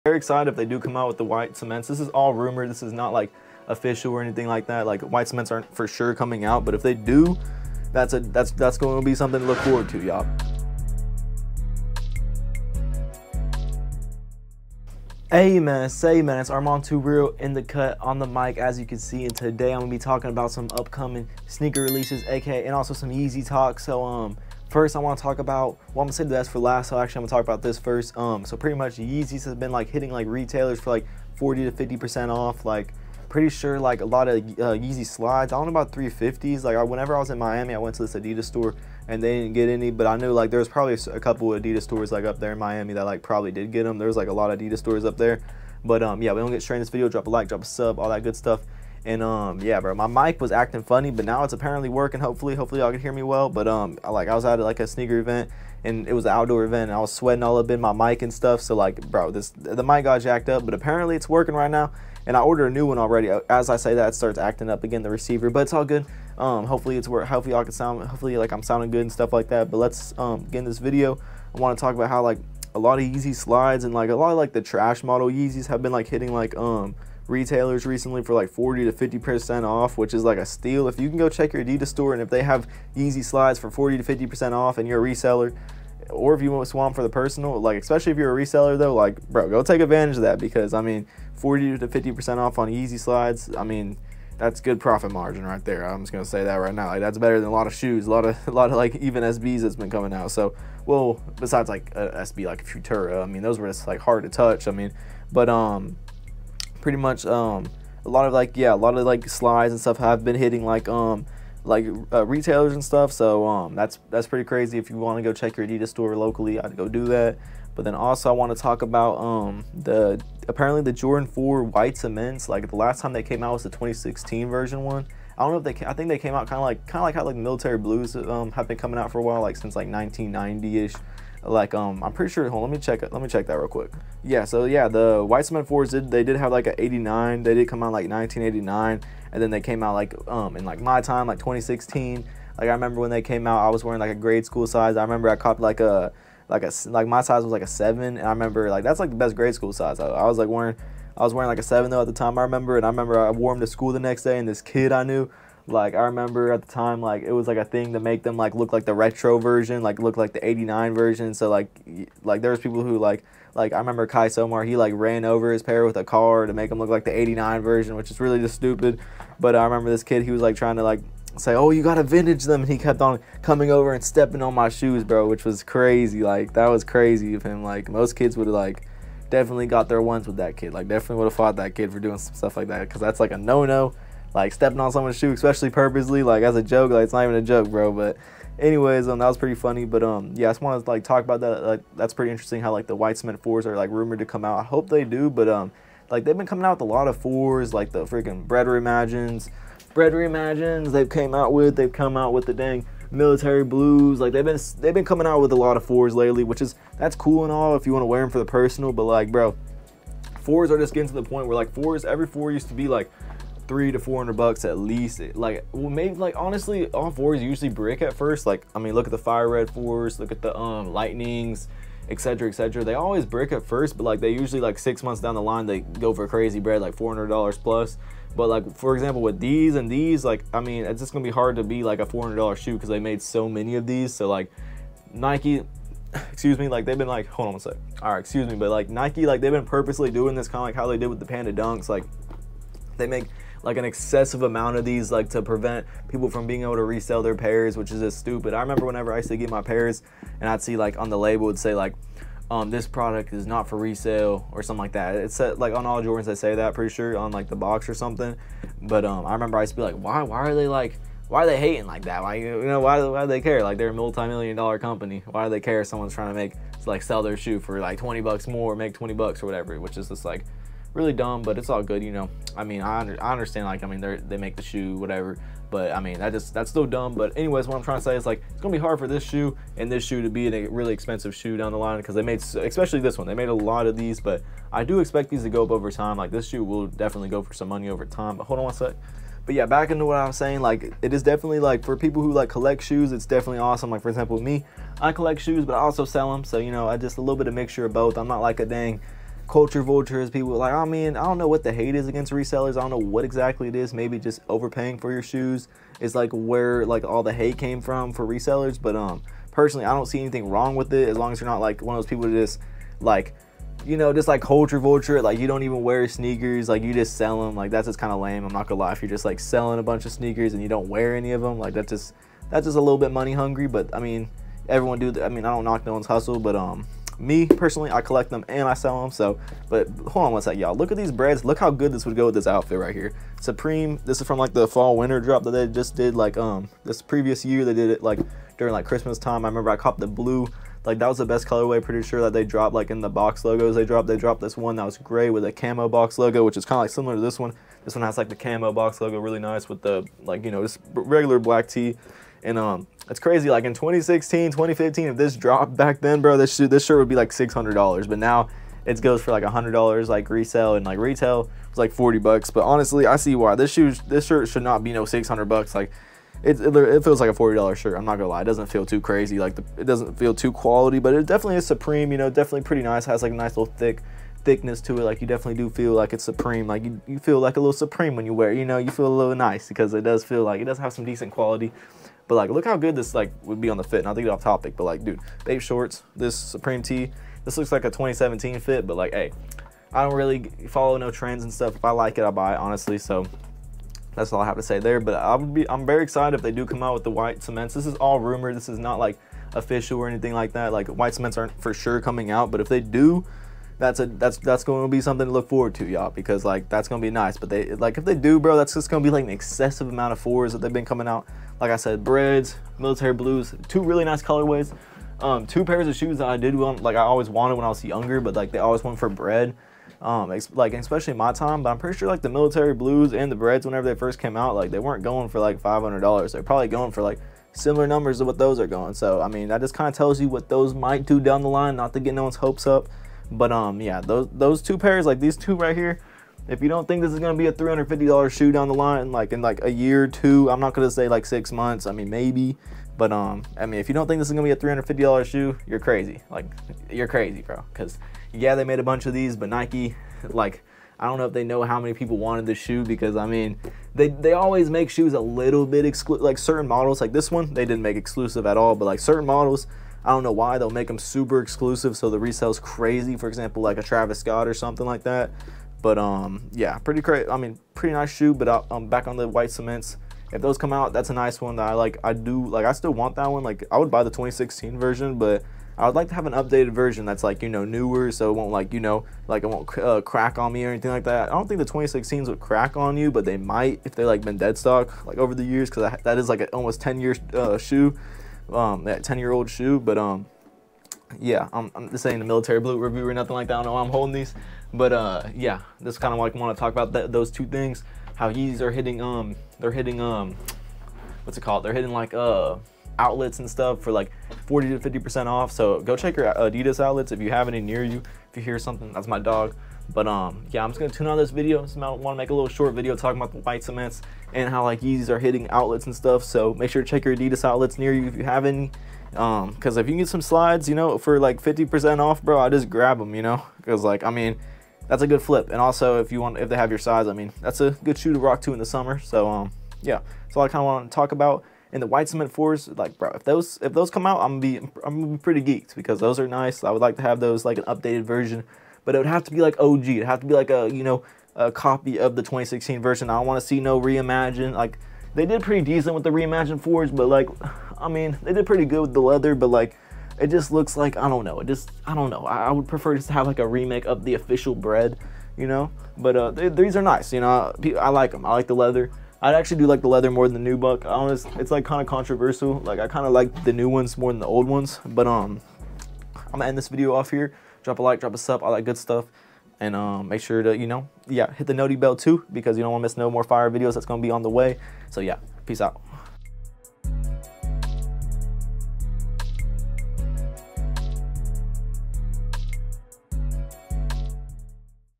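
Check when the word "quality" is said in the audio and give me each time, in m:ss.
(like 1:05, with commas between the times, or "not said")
6:10, 6:21.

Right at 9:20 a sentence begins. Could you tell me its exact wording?
I honest, it's like kind of controversial.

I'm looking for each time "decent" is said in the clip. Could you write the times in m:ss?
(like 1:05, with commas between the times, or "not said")
6:21, 9:05.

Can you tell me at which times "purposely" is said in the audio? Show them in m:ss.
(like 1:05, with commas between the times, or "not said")
3:05, 3:59.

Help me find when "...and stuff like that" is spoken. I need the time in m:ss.
1:09.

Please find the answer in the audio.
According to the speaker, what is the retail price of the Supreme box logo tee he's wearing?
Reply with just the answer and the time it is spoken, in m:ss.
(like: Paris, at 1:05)
$40, at 6:01.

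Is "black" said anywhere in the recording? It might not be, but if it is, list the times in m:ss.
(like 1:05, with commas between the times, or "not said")
5:51.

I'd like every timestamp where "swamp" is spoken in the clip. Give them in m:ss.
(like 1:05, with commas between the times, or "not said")
1:26.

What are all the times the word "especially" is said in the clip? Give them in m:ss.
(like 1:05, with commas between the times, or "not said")
1:27, 3:05, 4:42, 7:00.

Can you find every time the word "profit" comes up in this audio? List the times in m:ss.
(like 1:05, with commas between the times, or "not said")
1:34.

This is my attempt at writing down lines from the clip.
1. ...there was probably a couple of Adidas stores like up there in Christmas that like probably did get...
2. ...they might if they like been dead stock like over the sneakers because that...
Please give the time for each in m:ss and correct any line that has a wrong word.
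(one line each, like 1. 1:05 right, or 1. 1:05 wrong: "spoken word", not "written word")
1. 0:40 wrong: "Miami", not "Christmas"
2. 8:03 wrong: "years", not "sneakers".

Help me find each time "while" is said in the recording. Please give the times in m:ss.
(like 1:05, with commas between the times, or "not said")
2:09.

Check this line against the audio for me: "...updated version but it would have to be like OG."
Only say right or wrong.
right.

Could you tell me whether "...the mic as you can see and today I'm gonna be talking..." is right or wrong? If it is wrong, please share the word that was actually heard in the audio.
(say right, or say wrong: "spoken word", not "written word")
right.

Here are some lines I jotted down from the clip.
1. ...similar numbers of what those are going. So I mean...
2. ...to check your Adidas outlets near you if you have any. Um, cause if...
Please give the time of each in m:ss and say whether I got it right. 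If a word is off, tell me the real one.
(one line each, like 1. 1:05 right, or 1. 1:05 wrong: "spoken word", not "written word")
1. 7:07 right
2. 8:36 right.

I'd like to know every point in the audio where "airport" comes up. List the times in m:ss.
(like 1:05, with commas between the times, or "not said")
not said.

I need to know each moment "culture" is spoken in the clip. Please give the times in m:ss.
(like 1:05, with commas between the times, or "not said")
4:59, 5:14.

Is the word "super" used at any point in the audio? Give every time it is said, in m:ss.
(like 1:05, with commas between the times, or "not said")
7:40.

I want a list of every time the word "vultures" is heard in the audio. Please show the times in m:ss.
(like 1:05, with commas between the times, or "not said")
4:59, 5:14.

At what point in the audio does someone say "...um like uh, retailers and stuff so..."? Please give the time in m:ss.
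1:50.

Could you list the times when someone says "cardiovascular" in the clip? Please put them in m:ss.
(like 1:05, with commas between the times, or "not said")
not said.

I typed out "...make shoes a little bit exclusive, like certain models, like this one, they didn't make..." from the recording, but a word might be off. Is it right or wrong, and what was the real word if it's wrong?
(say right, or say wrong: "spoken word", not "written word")
right.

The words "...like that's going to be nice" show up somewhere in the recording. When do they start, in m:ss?
6:46.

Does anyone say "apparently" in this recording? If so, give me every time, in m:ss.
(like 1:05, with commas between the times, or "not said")
0:51, 1:00, 2:00.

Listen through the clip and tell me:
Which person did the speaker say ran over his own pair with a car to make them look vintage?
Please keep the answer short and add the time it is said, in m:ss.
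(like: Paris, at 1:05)
Kai Somar, at 2:44.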